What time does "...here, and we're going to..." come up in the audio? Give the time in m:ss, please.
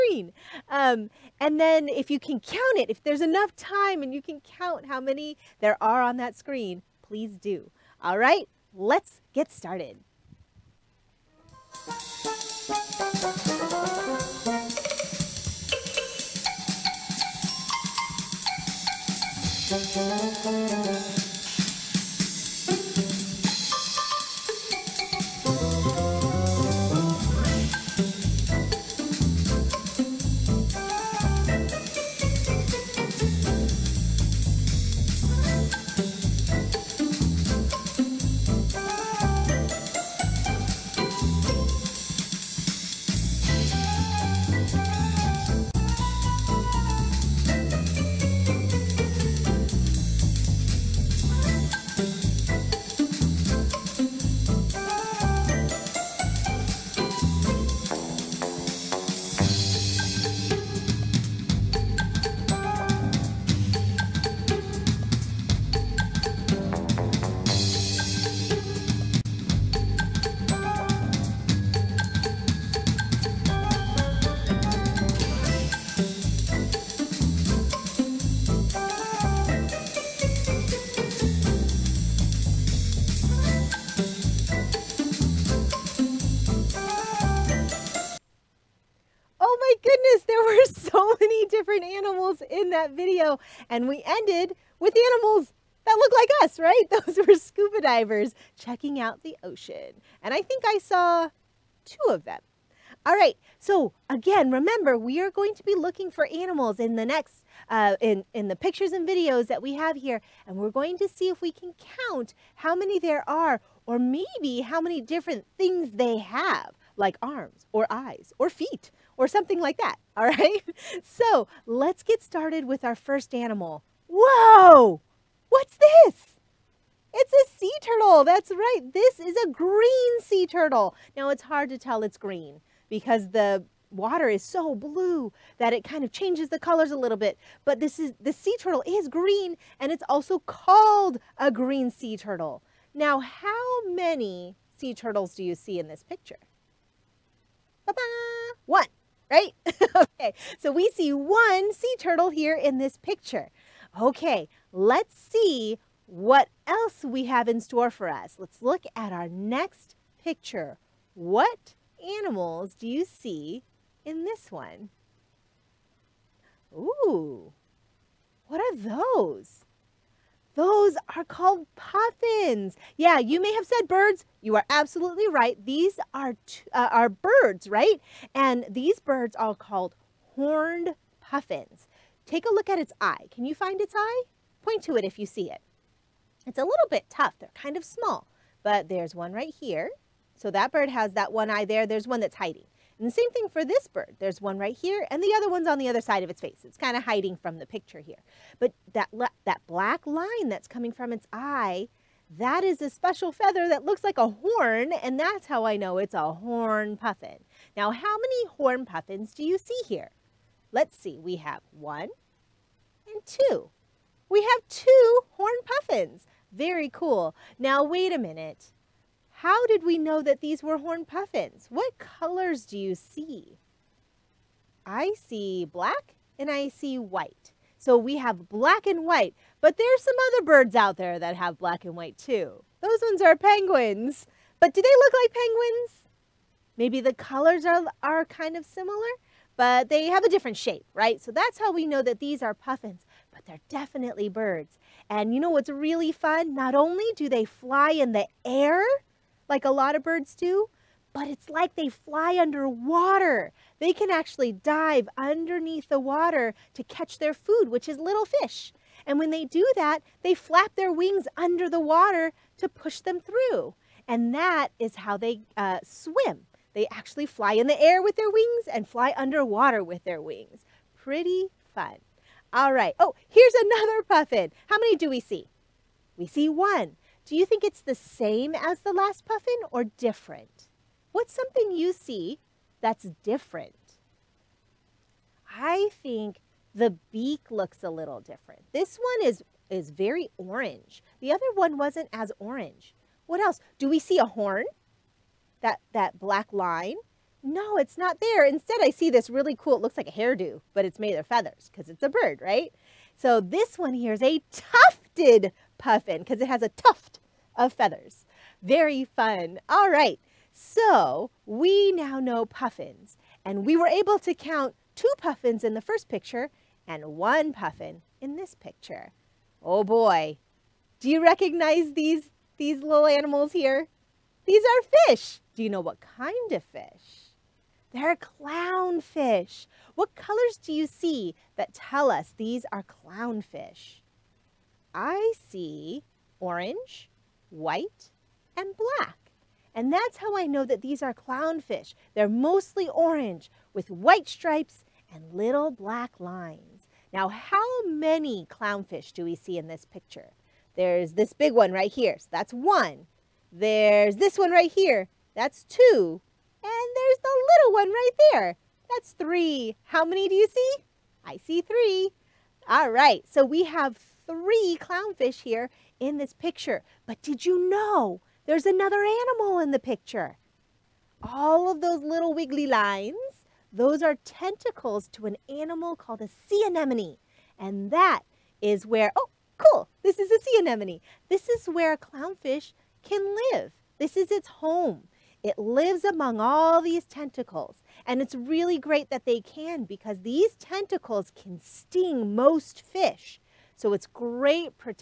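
1:49.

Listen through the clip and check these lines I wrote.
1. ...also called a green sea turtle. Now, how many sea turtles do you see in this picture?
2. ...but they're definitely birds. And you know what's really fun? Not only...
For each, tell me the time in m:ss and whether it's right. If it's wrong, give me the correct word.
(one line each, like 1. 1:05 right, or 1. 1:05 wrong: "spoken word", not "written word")
1. 2:20 right
2. 4:03 right.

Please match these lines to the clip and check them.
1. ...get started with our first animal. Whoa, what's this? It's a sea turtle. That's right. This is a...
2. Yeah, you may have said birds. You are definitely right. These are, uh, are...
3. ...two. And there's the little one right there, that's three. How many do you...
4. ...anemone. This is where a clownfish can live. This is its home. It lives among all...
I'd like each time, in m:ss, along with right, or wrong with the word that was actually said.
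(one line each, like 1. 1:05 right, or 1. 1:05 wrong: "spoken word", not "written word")
1. 2:02 right
2. 2:52 wrong: "absolutely", not "definitely"
3. 5:55 right
4. 6:20 right.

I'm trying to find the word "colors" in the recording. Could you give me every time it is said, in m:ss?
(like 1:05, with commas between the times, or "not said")
2:16, 3:41, 3:57, 5:30.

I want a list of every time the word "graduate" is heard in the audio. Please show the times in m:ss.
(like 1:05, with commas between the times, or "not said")
not said.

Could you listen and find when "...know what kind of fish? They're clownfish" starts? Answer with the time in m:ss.
5:25.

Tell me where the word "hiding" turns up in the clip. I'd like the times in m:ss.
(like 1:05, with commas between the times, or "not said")
3:12, 3:17.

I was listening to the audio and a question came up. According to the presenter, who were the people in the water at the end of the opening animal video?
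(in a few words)
scuba divers.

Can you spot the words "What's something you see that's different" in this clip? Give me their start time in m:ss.
4:41.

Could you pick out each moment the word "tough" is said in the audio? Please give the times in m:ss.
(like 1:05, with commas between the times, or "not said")
3:07.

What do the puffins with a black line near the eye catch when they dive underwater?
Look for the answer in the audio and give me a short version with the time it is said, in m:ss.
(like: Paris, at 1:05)
little fish, at 4:17.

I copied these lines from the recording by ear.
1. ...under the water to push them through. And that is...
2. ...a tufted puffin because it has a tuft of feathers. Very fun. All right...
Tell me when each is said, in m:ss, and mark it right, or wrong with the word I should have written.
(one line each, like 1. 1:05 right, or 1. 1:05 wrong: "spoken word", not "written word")
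1. 4:21 right
2. 5:04 right.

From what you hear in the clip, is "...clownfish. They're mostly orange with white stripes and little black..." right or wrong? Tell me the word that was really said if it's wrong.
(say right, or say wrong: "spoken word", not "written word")
right.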